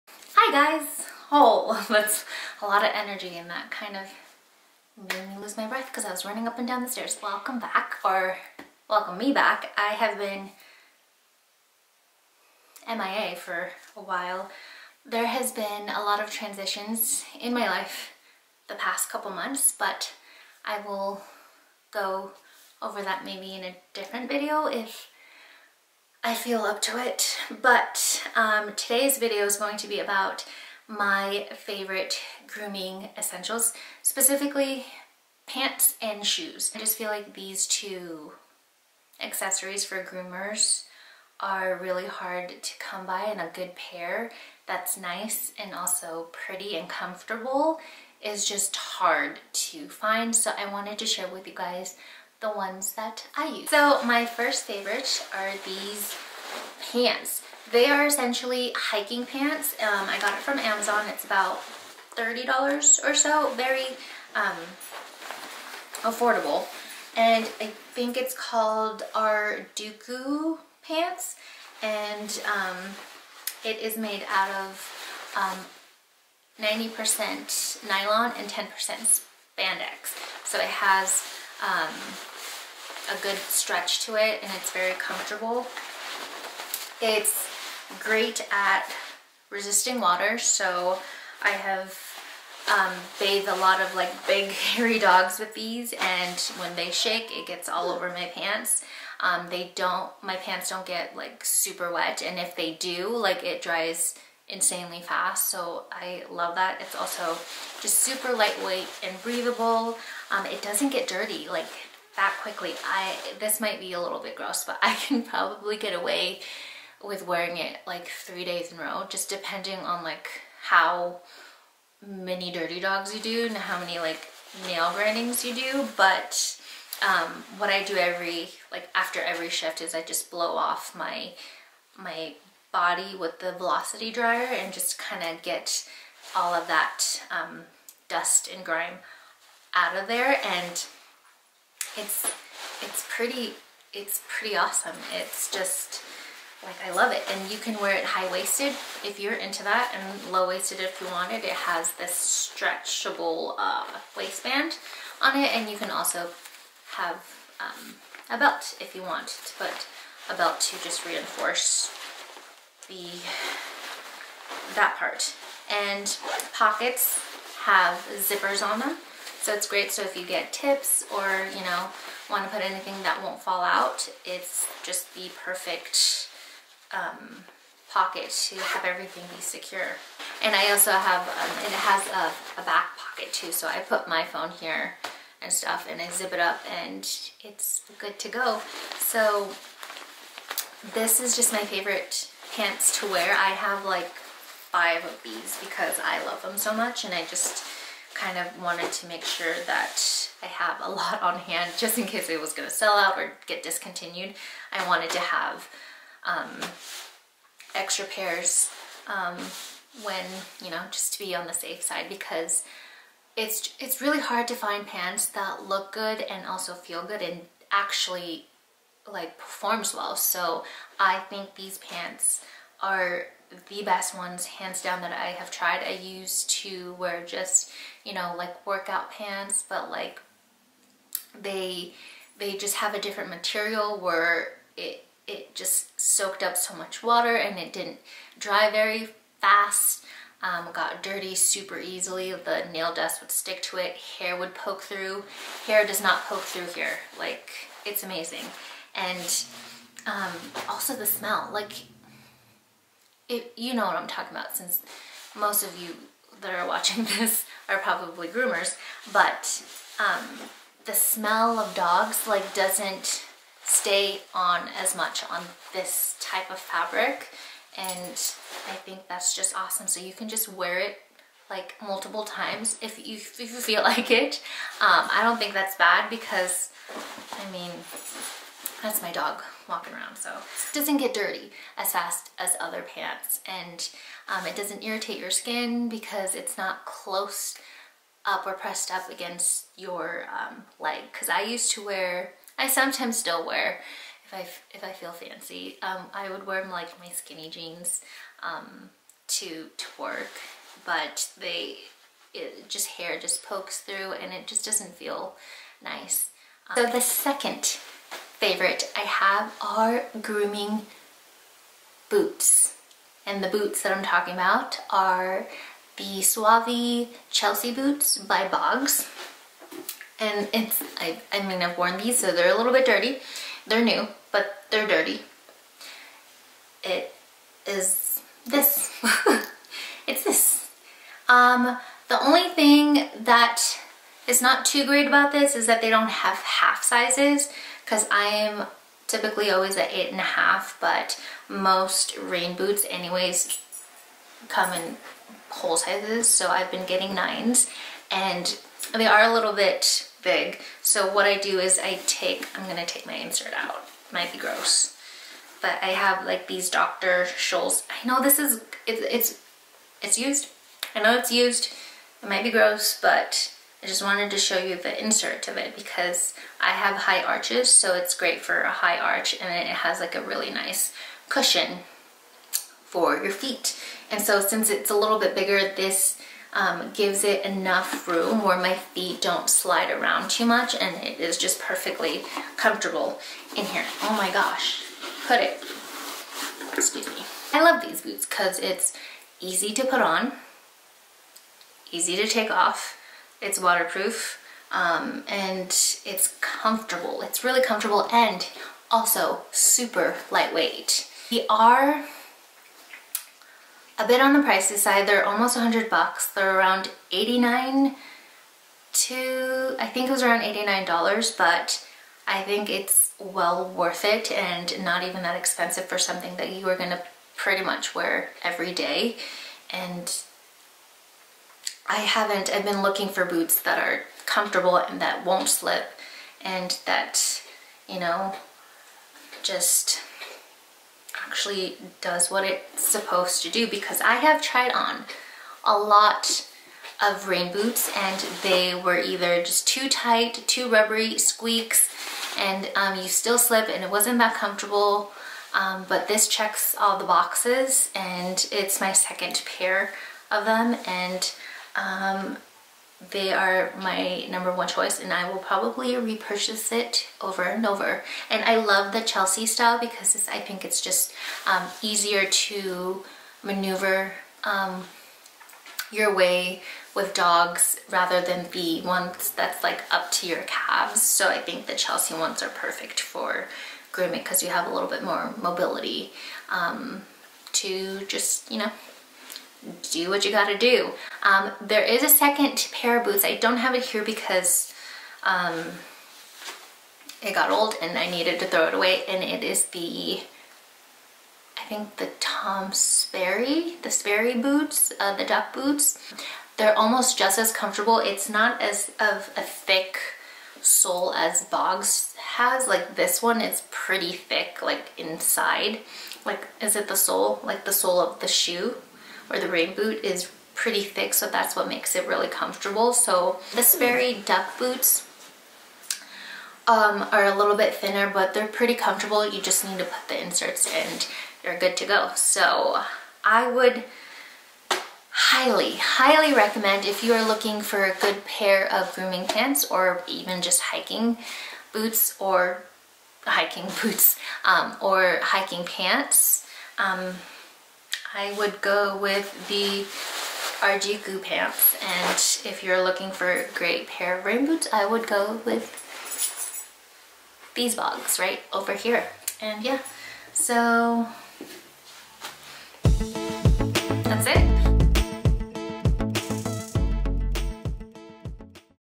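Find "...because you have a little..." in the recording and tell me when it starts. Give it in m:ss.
7:54.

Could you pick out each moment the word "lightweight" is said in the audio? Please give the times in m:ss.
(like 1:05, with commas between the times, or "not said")
1:48, 6:40.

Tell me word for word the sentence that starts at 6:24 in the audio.
Oh my gosh, put it, excuse me.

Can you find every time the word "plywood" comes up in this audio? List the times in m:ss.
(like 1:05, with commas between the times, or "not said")
not said.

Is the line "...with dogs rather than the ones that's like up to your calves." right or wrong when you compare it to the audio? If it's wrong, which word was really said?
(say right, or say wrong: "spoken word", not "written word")
right.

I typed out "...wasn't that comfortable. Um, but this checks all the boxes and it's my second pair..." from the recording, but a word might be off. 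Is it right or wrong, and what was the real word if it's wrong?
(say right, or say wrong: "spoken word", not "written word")
right.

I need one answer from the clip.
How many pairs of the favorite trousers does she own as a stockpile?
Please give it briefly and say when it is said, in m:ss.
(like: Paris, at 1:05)
5, at 3:14.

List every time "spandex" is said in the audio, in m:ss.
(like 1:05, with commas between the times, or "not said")
1:18.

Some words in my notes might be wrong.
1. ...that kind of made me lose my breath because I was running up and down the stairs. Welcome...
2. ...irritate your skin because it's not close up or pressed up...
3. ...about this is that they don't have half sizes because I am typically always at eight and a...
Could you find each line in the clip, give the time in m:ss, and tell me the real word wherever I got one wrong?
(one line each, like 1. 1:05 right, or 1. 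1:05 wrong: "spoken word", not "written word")
1. 0:03 right
2. 4:44 right
3. 5:35 right.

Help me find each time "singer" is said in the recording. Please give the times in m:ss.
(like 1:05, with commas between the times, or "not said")
not said.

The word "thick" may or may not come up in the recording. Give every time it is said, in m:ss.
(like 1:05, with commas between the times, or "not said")
8:19, 8:24, 8:30.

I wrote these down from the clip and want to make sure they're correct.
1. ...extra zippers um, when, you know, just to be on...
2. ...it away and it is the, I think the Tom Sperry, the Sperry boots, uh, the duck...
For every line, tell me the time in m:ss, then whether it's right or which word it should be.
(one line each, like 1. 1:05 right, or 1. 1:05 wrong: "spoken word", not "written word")
1. 3:27 wrong: "pairs", not "zippers"
2. 8:08 right.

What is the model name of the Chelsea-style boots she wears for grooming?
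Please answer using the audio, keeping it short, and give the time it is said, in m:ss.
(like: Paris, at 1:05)
Sauvie, at 5:16.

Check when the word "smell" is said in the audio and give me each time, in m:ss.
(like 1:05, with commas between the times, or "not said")
4:11, 4:20.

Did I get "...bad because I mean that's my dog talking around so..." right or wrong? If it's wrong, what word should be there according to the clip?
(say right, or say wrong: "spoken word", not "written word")
wrong: "walking", not "talking".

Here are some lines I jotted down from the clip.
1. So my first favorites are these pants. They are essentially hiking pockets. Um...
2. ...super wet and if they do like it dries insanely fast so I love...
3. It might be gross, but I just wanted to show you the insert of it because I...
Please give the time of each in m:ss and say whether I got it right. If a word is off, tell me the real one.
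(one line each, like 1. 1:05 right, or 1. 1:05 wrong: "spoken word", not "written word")
1. 0:53 wrong: "pants", not "pockets"
2. 1:41 right
3. 6:02 right.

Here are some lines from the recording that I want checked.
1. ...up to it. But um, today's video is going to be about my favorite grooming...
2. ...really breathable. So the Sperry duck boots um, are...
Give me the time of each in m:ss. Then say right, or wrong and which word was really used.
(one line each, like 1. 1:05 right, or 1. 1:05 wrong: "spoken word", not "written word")
1. 0:26 right
2. 8:32 wrong: "comfortable", not "breathable".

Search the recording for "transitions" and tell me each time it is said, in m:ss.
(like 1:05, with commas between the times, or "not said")
0:16.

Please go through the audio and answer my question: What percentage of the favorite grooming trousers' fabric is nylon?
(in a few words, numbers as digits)
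90%.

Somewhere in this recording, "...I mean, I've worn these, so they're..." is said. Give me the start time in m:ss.
5:21.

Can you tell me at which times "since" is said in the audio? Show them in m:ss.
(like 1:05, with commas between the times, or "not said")
4:14, 6:14.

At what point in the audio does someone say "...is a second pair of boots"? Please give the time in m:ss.
8:01.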